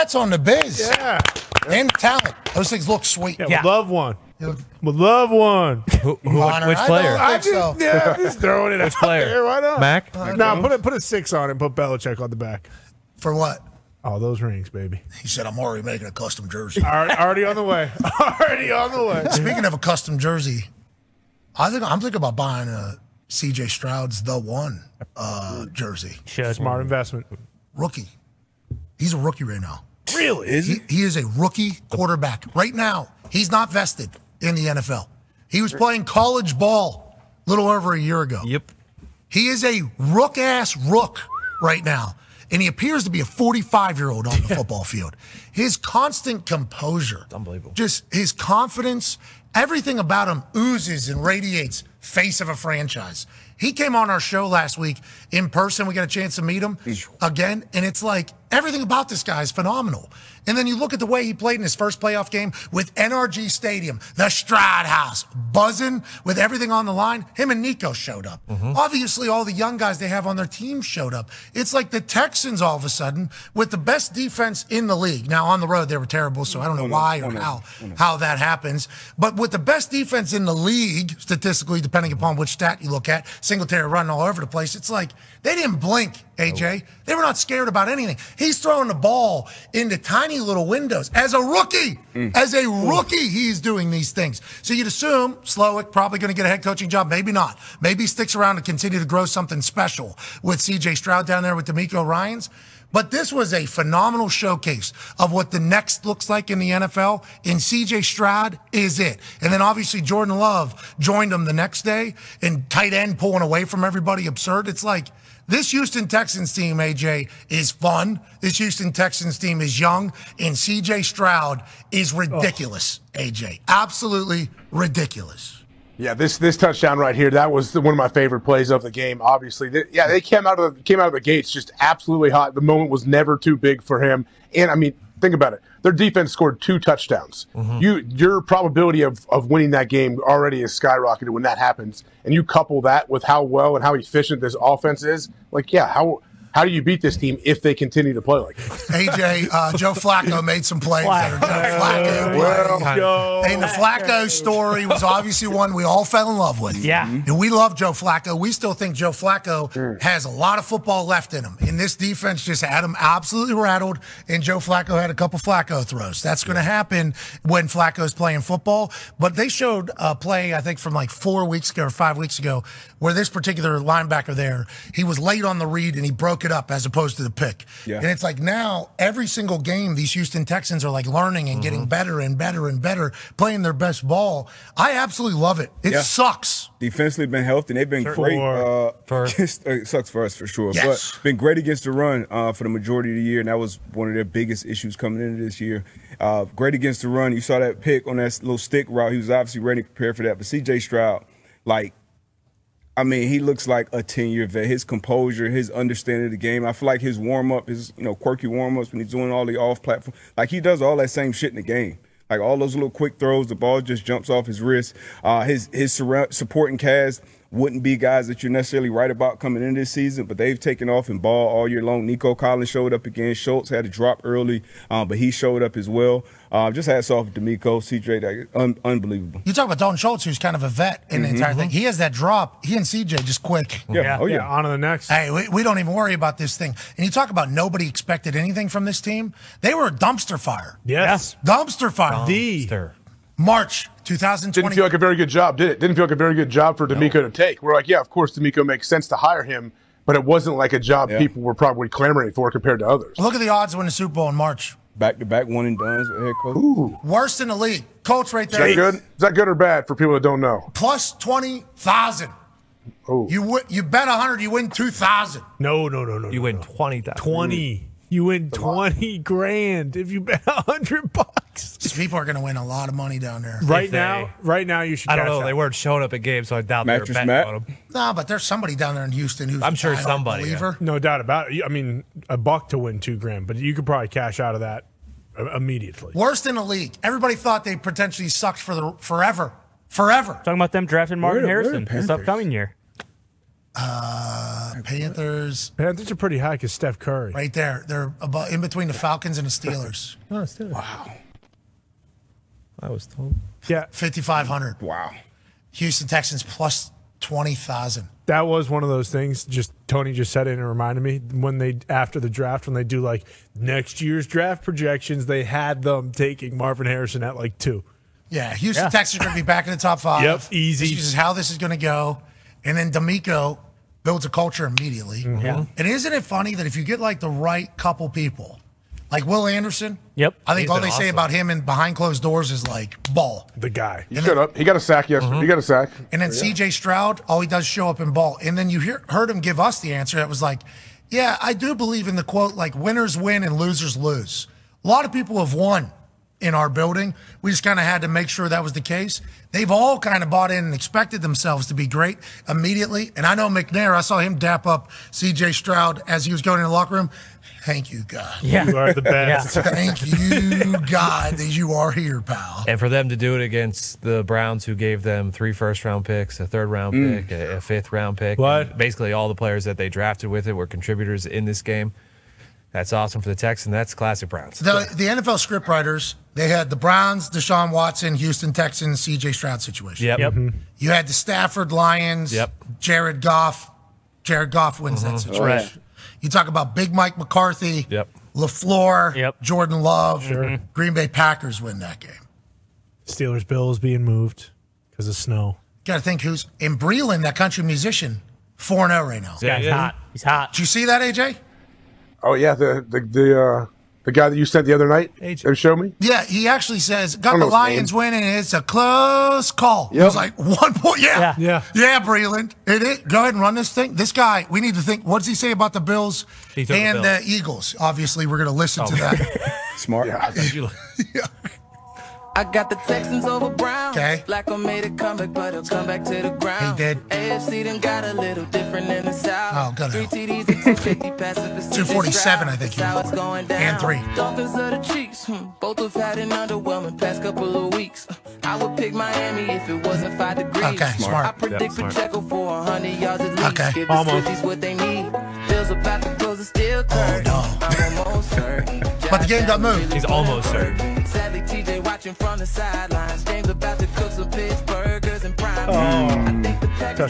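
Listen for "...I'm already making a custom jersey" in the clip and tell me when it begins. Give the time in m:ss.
0:15.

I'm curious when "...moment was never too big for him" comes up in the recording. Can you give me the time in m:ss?
2:12.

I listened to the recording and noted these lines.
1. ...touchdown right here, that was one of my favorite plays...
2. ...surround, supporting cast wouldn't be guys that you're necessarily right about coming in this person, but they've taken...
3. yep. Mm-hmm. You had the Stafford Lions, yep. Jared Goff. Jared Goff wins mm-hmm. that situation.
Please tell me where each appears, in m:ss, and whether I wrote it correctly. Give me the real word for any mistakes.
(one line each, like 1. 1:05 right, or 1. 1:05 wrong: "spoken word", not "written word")
1. 2:06 right
2. 3:35 wrong: "season", not "person"
3. 6:20 right.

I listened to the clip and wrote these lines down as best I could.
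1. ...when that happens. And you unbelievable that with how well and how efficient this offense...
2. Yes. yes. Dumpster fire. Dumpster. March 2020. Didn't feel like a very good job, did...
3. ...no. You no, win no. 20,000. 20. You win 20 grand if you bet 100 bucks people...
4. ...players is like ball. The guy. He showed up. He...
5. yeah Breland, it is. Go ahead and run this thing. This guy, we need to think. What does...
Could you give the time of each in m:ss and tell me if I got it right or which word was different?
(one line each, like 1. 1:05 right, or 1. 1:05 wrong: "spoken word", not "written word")
1. 2:21 wrong: "couple", not "unbelievable"
2. 4:00 right
3. 4:26 right
4. 5:32 wrong: "doors", not "players"
5. 6:51 right.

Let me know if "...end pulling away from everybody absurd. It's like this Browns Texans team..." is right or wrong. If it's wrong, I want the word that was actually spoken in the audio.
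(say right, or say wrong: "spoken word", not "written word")
wrong: "Houston", not "Browns".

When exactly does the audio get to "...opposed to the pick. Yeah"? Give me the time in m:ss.
2:56.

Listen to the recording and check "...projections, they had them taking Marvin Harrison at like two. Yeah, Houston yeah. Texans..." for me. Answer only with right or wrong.
right.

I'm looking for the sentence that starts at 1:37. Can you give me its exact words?
Maybe he sticks around and continue to grow something special with CJ Stroud down there with DeMeco Ryans.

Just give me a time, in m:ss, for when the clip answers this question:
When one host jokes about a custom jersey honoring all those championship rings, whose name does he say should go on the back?
0:11.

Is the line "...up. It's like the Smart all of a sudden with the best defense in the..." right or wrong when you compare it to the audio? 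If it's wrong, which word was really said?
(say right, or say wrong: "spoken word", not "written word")
wrong: "Texans", not "Smart".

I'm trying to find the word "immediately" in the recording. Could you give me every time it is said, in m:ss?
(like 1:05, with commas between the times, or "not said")
4:45, 5:24, 5:52.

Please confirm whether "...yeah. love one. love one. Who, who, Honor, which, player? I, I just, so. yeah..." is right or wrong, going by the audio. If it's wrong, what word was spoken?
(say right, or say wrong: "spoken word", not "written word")
right.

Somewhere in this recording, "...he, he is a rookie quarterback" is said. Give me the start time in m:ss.
0:30.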